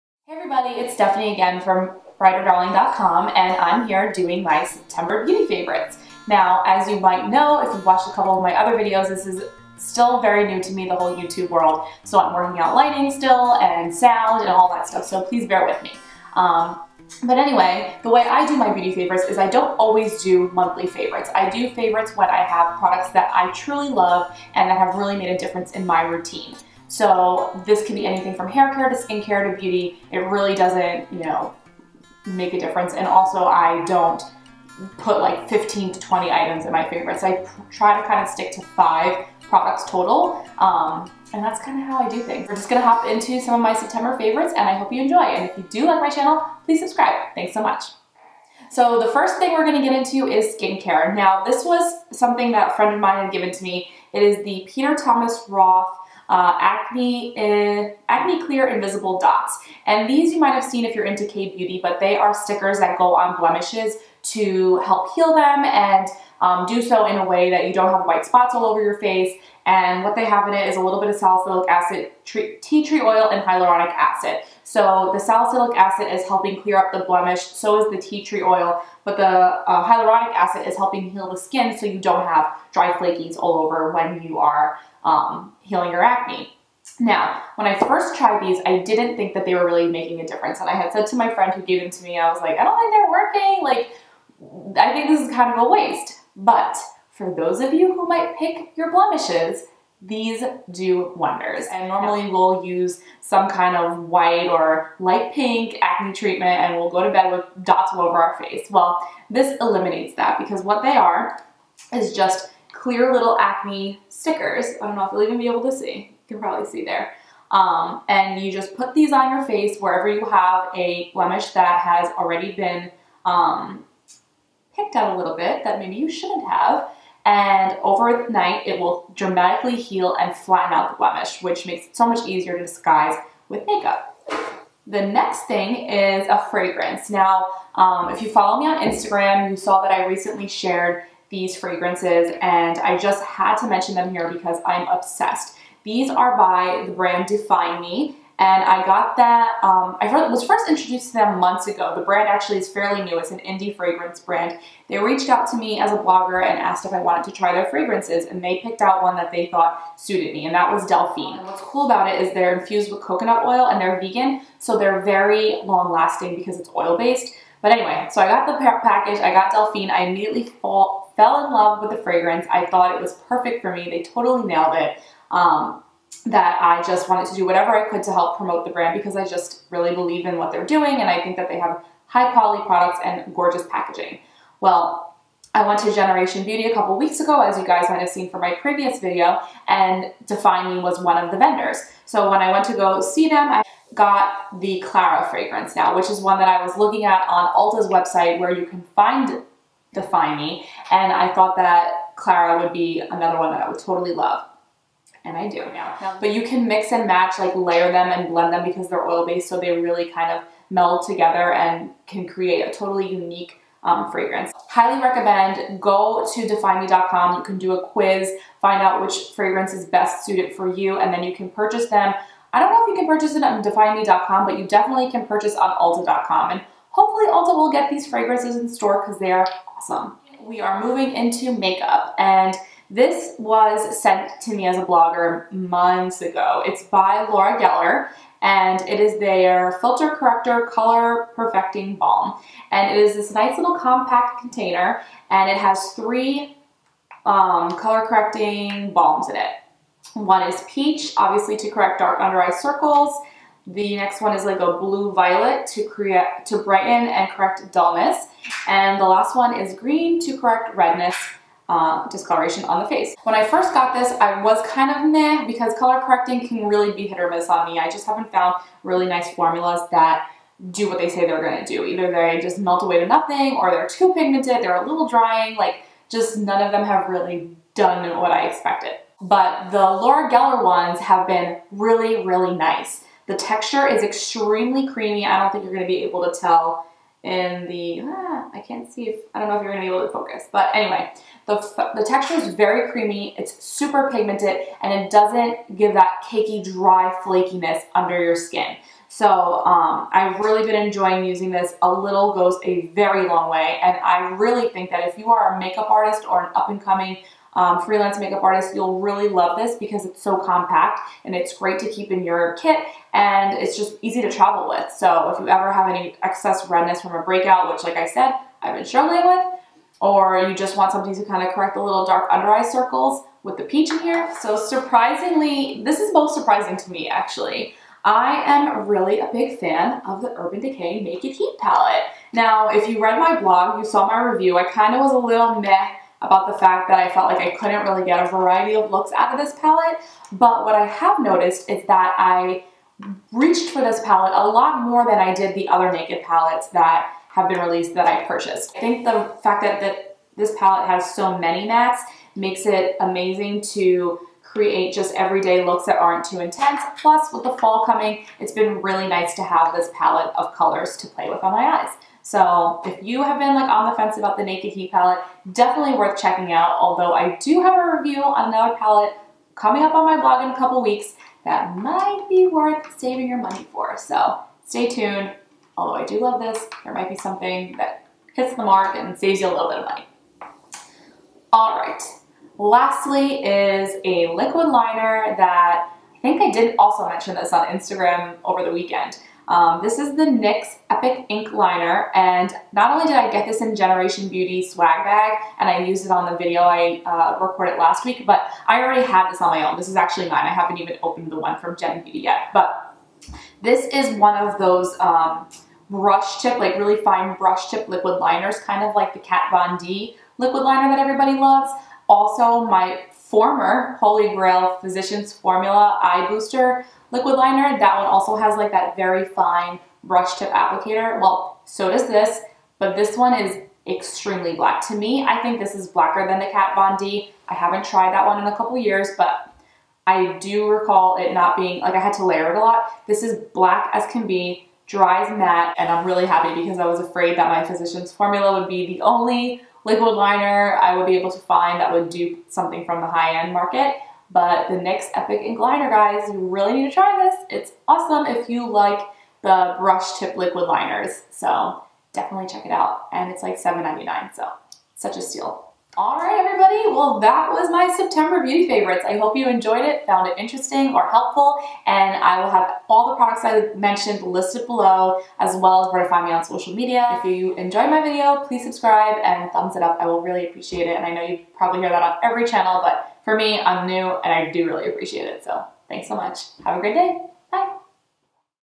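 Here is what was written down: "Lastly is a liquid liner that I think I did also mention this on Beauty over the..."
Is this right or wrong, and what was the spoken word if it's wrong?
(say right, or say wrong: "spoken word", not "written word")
wrong: "Instagram", not "Beauty".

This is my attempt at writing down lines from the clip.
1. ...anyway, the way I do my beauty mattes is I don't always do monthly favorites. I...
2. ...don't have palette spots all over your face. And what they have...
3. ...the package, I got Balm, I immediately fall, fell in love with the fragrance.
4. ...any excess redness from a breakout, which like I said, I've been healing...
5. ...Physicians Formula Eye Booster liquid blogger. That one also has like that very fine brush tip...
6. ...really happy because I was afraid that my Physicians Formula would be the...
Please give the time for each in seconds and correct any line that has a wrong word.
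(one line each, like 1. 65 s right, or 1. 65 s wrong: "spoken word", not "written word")
1. 17 s wrong: "favorites", not "mattes"
2. 67 s wrong: "white", not "palette"
3. 168 s wrong: "Delphine", not "Balm"
4. 315 s wrong: "struggling", not "healing"
5. 414 s wrong: "liner", not "blogger"
6. 436 s right.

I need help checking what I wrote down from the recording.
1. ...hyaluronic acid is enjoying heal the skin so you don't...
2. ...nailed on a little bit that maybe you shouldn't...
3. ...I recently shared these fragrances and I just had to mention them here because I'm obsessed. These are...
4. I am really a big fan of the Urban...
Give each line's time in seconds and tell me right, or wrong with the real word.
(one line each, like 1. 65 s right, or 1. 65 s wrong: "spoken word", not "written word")
1. 79 s wrong: "helping", not "enjoying"
2. 124 s wrong: "picked", not "nailed"
3. 139 s right
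4. 328 s right.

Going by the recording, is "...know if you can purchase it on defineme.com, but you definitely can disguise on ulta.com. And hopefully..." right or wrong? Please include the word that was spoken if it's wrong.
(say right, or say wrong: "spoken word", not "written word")
wrong: "purchase", not "disguise".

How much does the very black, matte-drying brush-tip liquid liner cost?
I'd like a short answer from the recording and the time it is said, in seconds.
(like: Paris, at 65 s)
$7.99, at 453 s.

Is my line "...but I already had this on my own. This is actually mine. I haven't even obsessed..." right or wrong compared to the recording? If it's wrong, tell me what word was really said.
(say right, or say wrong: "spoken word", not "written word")
wrong: "opened", not "obsessed".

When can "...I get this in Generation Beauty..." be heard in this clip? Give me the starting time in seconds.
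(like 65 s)
393 s.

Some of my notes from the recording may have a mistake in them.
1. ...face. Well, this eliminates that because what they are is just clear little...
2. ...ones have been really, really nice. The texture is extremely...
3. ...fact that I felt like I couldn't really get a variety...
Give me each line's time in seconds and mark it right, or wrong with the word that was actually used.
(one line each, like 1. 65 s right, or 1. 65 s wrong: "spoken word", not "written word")
1. 108 s right
2. 280 s right
3. 336 s right.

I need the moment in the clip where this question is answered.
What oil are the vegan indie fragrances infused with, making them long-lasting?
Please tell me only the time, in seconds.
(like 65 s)
163 s.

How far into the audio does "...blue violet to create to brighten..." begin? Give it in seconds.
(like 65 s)
254 s.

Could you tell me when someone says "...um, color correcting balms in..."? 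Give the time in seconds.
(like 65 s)
247 s.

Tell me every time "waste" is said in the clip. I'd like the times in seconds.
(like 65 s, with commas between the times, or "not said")
95 s.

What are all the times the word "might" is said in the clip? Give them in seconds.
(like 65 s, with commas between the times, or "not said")
6 s, 60 s, 98 s, 187 s, 371 s, 376 s.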